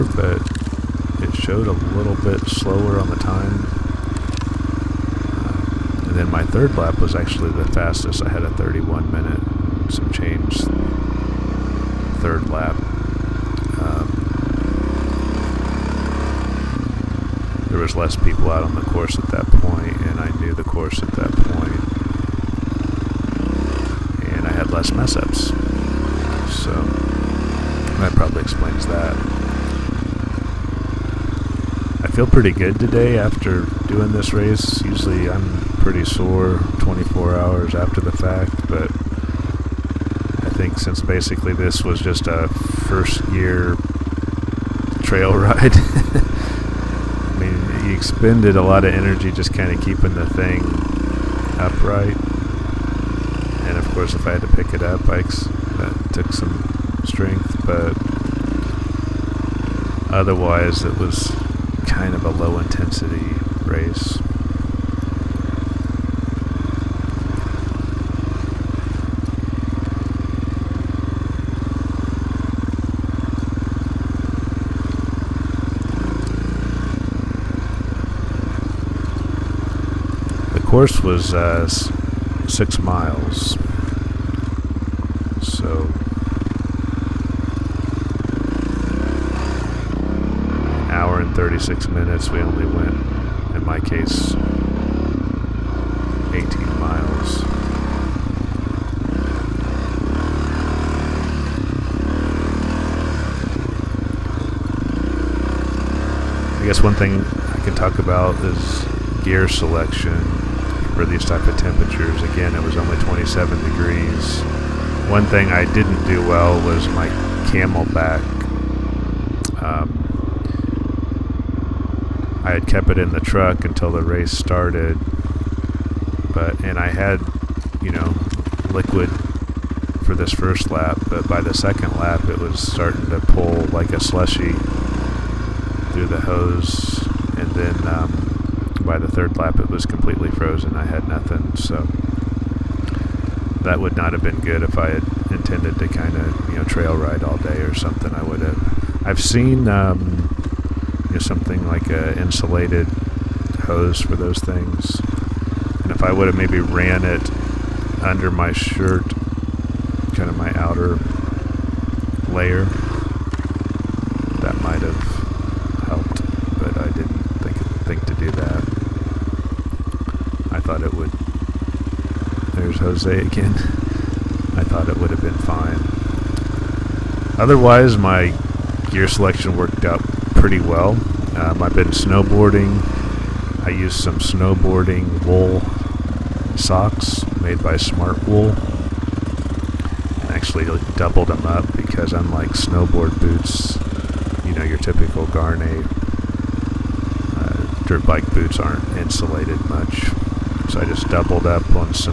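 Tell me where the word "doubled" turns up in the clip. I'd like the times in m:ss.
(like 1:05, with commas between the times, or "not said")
3:10, 3:21.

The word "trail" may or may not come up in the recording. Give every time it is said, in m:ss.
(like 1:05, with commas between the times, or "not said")
0:45, 2:26.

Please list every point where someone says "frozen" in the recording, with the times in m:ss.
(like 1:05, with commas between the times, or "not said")
2:20.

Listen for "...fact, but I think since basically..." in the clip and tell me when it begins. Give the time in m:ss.
0:38.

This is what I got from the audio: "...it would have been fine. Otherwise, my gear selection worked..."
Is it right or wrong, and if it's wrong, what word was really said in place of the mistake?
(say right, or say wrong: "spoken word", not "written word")
right.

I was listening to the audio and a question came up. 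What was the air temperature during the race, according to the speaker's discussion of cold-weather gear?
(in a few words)
27 degrees.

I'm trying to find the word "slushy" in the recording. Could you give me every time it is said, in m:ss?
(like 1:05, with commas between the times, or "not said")
2:13.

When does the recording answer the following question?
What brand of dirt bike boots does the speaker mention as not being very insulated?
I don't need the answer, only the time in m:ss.
3:15.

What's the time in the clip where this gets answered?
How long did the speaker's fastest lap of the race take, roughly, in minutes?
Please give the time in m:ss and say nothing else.
0:08.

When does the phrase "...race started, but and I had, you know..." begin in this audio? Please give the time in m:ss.
2:04.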